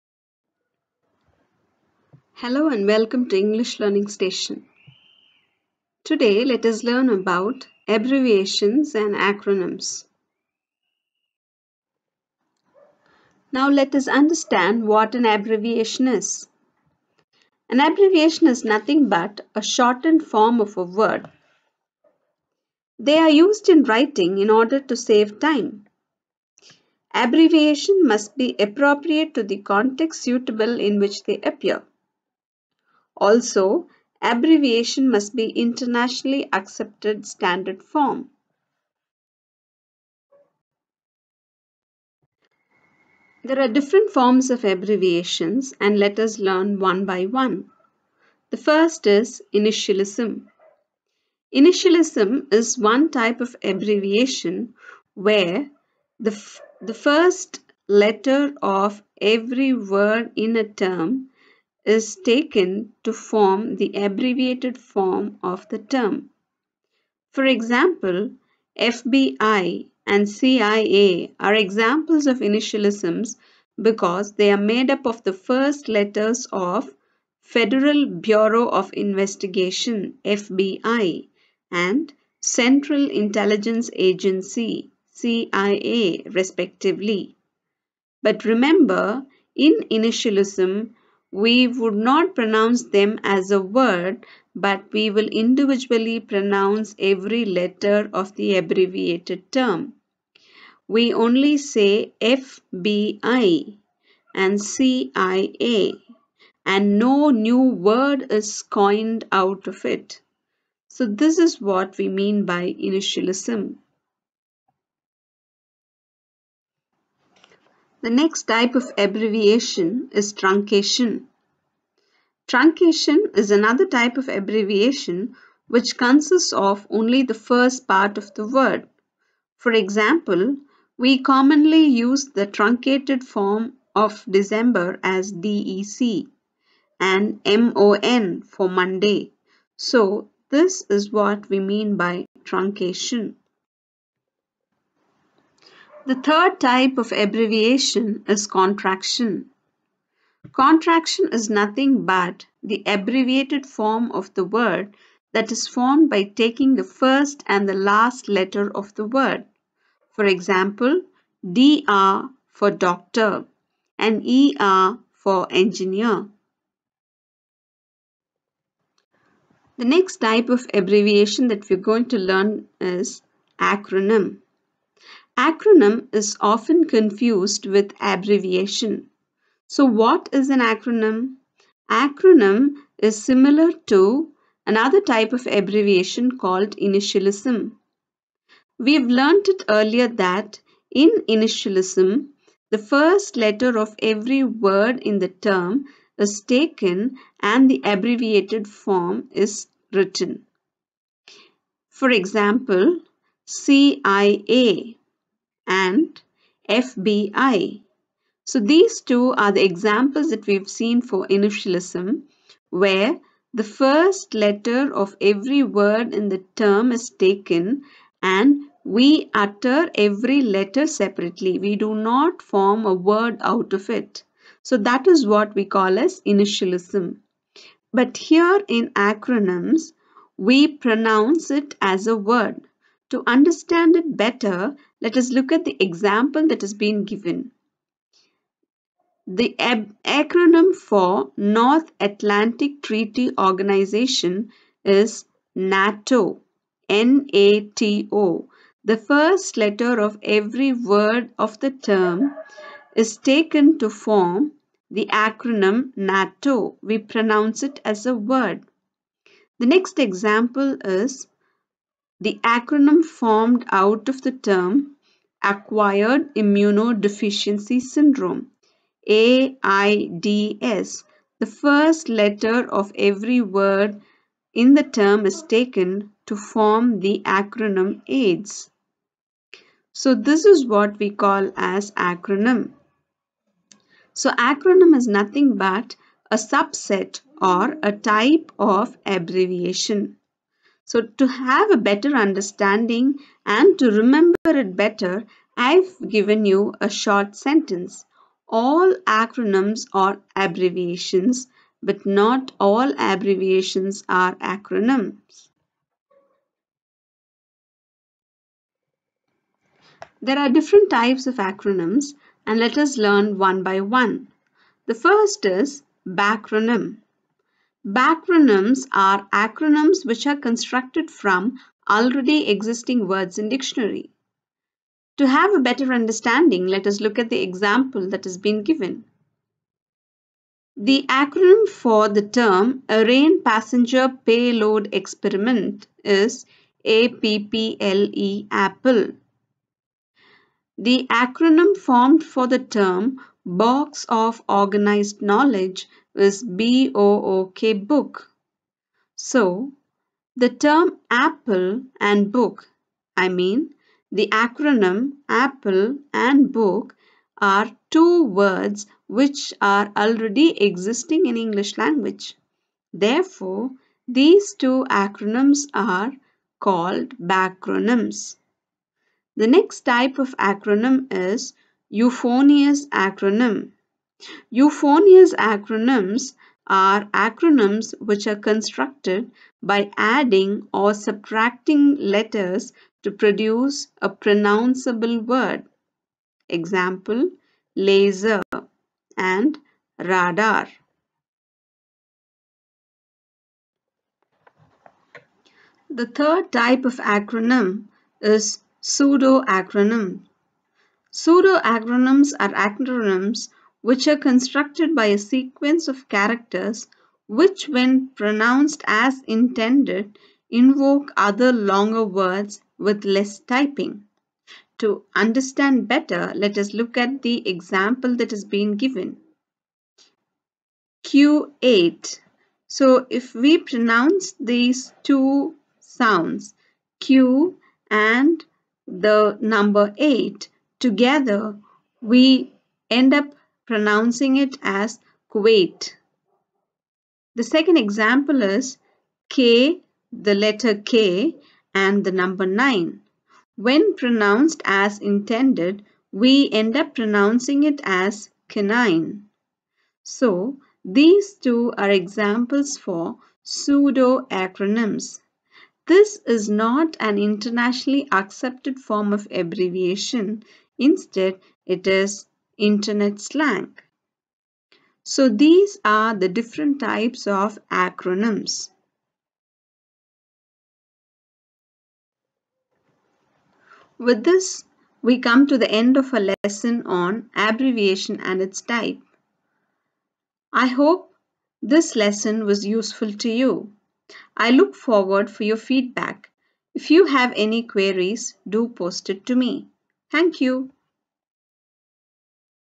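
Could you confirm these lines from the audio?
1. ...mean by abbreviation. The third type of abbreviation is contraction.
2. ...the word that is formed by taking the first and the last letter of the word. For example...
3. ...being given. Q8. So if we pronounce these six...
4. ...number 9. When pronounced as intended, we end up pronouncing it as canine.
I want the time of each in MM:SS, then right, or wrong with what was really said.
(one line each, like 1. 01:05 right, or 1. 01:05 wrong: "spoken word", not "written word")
1. 02:21 wrong: "truncation", not "abbreviation"
2. 02:34 right
3. 06:58 wrong: "two", not "six"
4. 07:22 right.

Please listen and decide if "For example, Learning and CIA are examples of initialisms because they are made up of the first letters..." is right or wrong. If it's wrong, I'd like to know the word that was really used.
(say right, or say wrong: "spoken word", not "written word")
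wrong: "FBI", not "Learning".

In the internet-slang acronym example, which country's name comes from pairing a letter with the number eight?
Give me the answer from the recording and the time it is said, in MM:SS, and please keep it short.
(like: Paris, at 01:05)
Kuwait, at 07:15.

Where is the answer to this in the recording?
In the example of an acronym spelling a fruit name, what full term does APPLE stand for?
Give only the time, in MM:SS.
05:32.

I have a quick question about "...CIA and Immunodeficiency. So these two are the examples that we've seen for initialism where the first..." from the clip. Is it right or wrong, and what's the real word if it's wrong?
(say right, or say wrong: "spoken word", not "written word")
wrong: "FBI", not "Immunodeficiency".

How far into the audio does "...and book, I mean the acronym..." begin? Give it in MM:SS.
05:51.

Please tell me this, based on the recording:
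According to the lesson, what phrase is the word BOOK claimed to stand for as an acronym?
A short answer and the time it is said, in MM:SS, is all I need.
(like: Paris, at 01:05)
Box of organized knowledge, at 05:43.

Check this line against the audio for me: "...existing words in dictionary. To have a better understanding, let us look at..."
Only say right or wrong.
right.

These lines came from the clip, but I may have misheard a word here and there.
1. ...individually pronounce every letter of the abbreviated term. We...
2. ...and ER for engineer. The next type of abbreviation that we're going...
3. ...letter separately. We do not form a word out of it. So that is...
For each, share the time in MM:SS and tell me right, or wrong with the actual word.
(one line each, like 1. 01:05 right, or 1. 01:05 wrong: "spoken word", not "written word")
1. 01:35 right
2. 02:43 right
3. 03:40 right.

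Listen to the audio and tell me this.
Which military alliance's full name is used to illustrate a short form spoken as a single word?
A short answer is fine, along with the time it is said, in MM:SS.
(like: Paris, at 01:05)
North Atlantic Treaty Organization, at 04:01.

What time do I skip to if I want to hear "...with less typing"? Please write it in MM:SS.
06:52.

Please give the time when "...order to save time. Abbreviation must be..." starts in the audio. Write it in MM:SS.
00:24.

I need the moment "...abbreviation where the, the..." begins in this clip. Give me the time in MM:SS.
00:53.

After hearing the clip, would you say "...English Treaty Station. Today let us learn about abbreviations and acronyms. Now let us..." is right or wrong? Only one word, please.
wrong.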